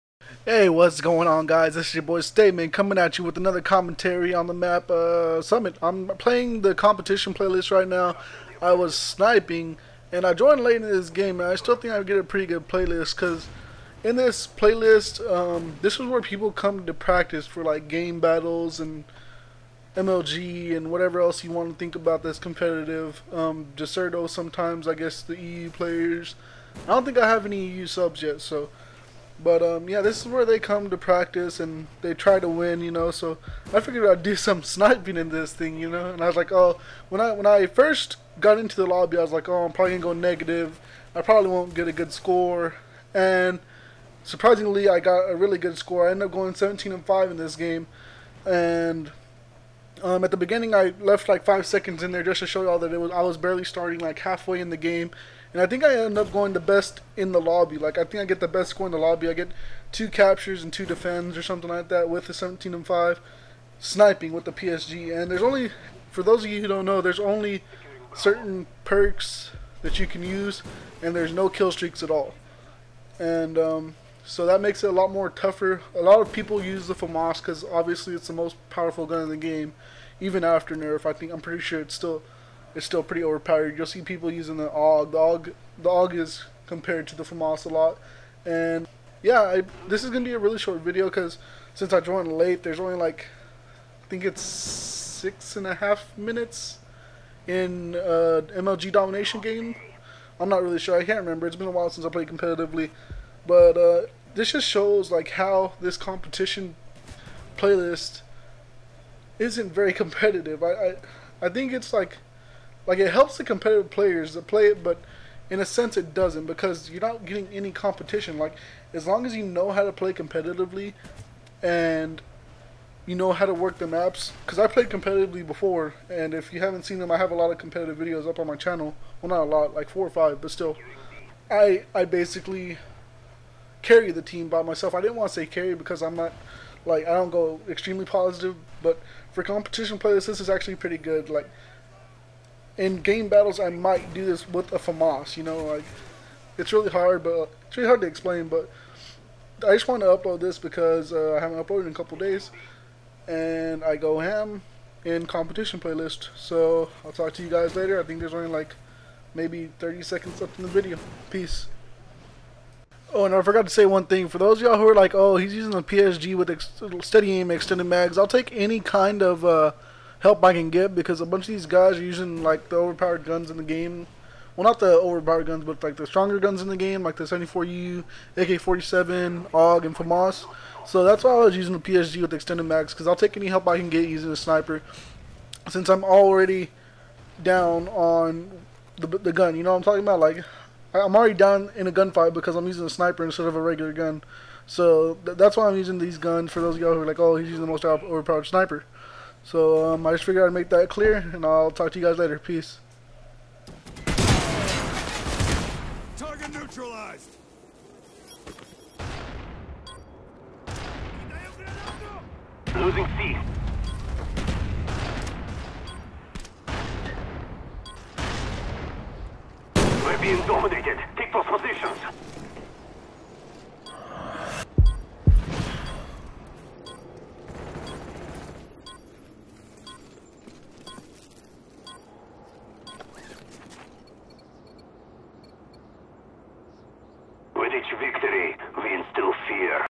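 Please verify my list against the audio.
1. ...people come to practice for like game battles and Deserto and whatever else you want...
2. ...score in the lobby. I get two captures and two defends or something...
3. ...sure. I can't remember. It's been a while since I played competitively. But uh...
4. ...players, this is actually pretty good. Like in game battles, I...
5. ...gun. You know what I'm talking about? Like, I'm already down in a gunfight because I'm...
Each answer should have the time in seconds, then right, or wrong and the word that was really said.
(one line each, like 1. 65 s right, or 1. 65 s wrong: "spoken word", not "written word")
1. 16 s wrong: "MLG", not "Deserto"
2. 58 s right
3. 100 s right
4. 139 s right
5. 189 s right.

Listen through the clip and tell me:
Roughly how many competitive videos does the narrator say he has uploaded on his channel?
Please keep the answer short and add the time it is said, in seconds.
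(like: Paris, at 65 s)
4 or 5, at 129 s.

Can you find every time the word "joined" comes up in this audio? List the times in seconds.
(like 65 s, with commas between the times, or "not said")
10 s, 91 s.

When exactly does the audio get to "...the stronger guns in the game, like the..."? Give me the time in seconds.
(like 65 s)
175 s.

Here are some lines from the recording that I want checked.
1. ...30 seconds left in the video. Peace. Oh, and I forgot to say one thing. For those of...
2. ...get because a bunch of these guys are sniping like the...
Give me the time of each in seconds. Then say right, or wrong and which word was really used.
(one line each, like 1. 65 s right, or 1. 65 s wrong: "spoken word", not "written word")
1. 159 s right
2. 170 s wrong: "using", not "sniping".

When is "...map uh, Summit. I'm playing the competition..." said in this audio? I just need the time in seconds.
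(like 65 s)
4 s.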